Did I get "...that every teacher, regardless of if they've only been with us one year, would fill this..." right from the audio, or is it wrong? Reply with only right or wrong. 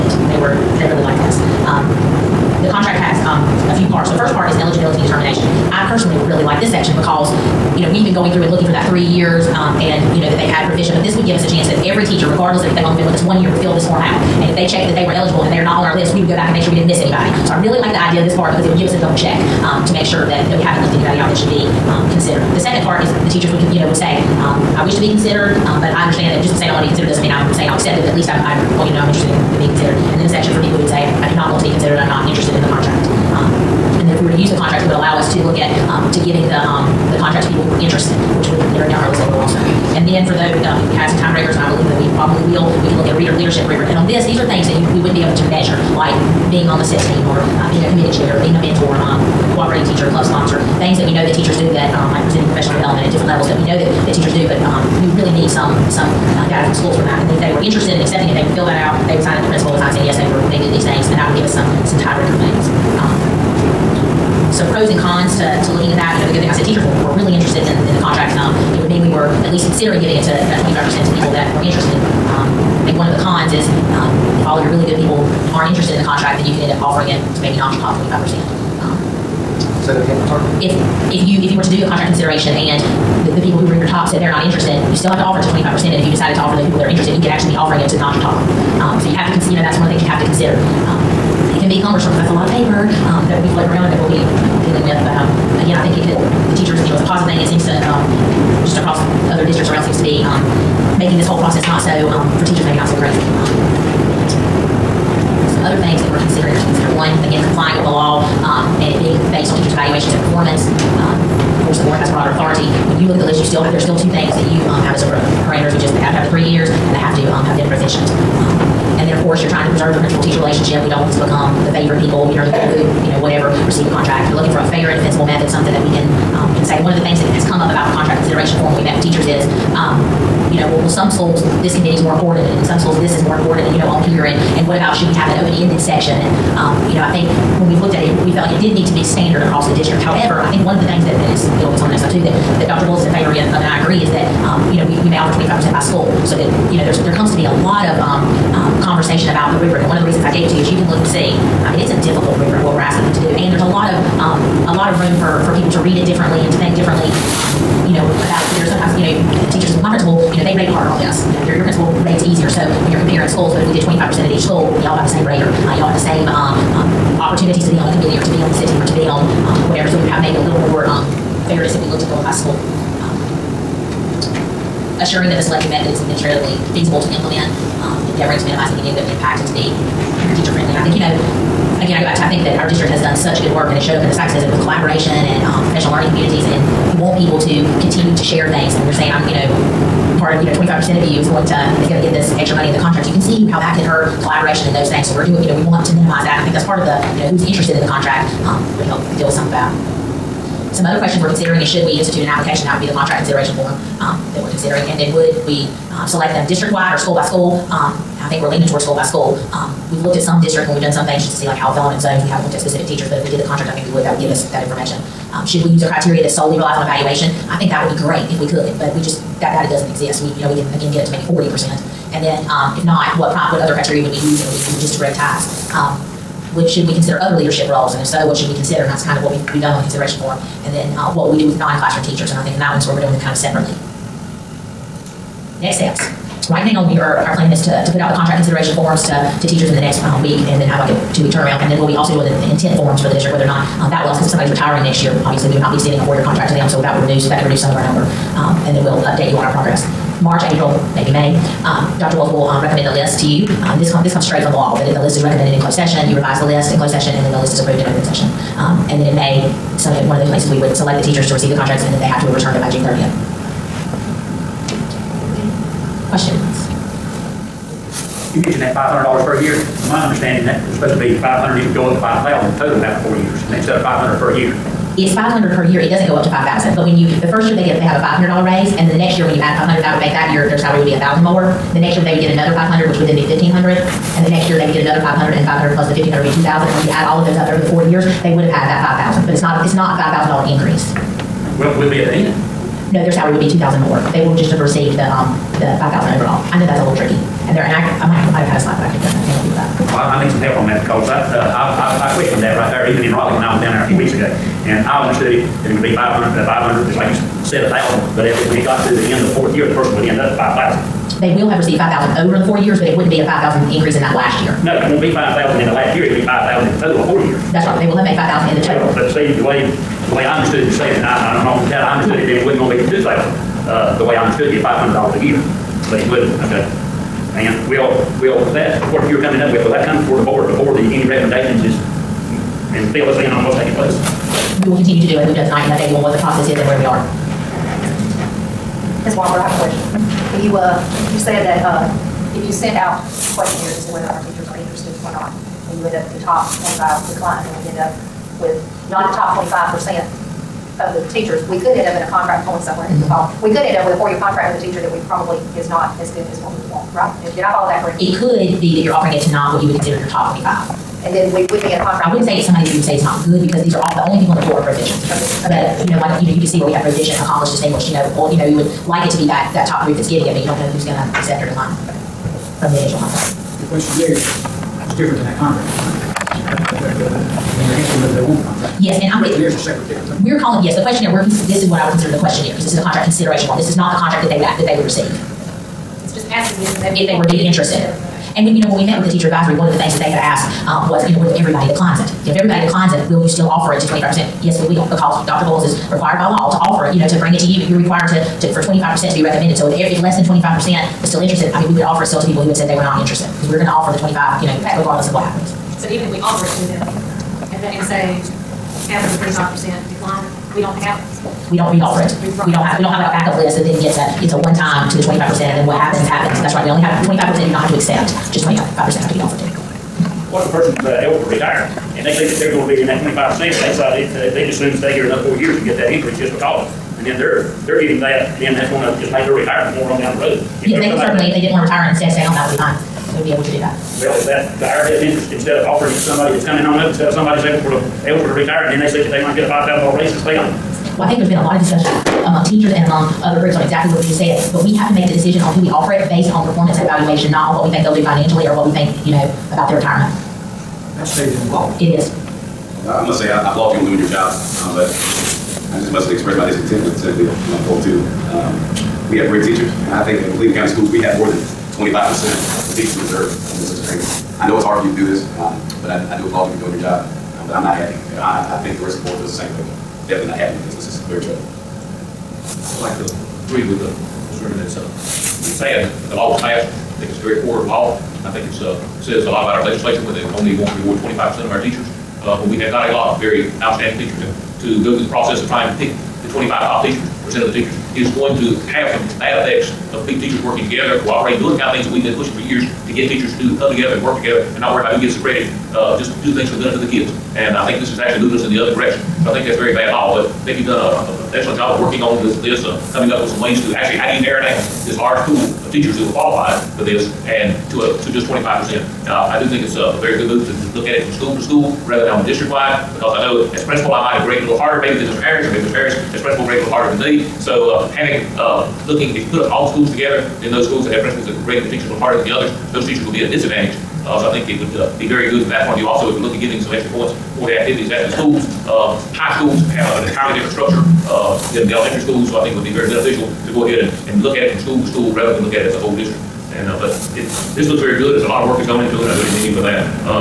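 right.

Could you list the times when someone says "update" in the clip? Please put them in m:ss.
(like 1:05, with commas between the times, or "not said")
4:09, 5:35.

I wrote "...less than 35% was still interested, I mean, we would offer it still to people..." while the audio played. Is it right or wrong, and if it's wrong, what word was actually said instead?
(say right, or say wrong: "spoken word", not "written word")
wrong: "25", not "35".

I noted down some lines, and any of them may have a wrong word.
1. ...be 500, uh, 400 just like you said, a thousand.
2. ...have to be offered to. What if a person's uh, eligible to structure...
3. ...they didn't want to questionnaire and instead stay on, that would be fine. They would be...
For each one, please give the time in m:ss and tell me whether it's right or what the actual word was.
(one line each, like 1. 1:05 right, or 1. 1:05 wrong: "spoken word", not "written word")
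1. 5:05 wrong: "500", not "400"
2. 6:59 wrong: "retire", not "structure"
3. 7:11 wrong: "retire", not "questionnaire".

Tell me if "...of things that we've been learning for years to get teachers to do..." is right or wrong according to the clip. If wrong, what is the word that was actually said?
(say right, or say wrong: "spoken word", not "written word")
wrong: "pushing", not "learning".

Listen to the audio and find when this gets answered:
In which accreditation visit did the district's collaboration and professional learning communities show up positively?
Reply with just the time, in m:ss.
3:04.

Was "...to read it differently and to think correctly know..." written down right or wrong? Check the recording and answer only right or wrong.
wrong.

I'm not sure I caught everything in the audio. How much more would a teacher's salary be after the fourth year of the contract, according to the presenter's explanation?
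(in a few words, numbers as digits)
2,000 dollars.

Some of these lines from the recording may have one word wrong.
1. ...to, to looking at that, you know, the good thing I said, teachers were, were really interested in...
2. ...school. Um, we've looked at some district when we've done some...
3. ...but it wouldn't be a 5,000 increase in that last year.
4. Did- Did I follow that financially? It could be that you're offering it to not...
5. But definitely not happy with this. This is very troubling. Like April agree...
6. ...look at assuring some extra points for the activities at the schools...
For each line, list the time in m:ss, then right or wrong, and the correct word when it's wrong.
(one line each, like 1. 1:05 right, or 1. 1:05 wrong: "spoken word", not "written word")
1. 1:05 right
2. 3:29 right
3. 5:12 right
4. 5:57 wrong: "correctly", not "financially"
5. 7:49 wrong: "Blackfield", not "April"
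6. 8:46 wrong: "giving", not "assuring".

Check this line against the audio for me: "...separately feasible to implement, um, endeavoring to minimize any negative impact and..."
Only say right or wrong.
wrong.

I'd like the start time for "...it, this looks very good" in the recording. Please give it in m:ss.
8:57.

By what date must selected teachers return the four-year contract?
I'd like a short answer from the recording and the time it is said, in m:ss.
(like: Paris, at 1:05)
June 30th, at 4:22.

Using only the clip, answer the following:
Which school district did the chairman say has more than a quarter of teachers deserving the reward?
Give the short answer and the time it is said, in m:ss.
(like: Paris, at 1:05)
Cleveland County Schools, at 7:40.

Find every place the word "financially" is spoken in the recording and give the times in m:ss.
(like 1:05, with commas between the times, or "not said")
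7:28.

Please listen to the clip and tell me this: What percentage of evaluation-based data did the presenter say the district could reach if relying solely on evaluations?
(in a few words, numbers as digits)
40%.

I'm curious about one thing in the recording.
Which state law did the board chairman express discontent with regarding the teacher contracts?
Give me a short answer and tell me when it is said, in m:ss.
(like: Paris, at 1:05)
Senate Bill 142, at 7:36.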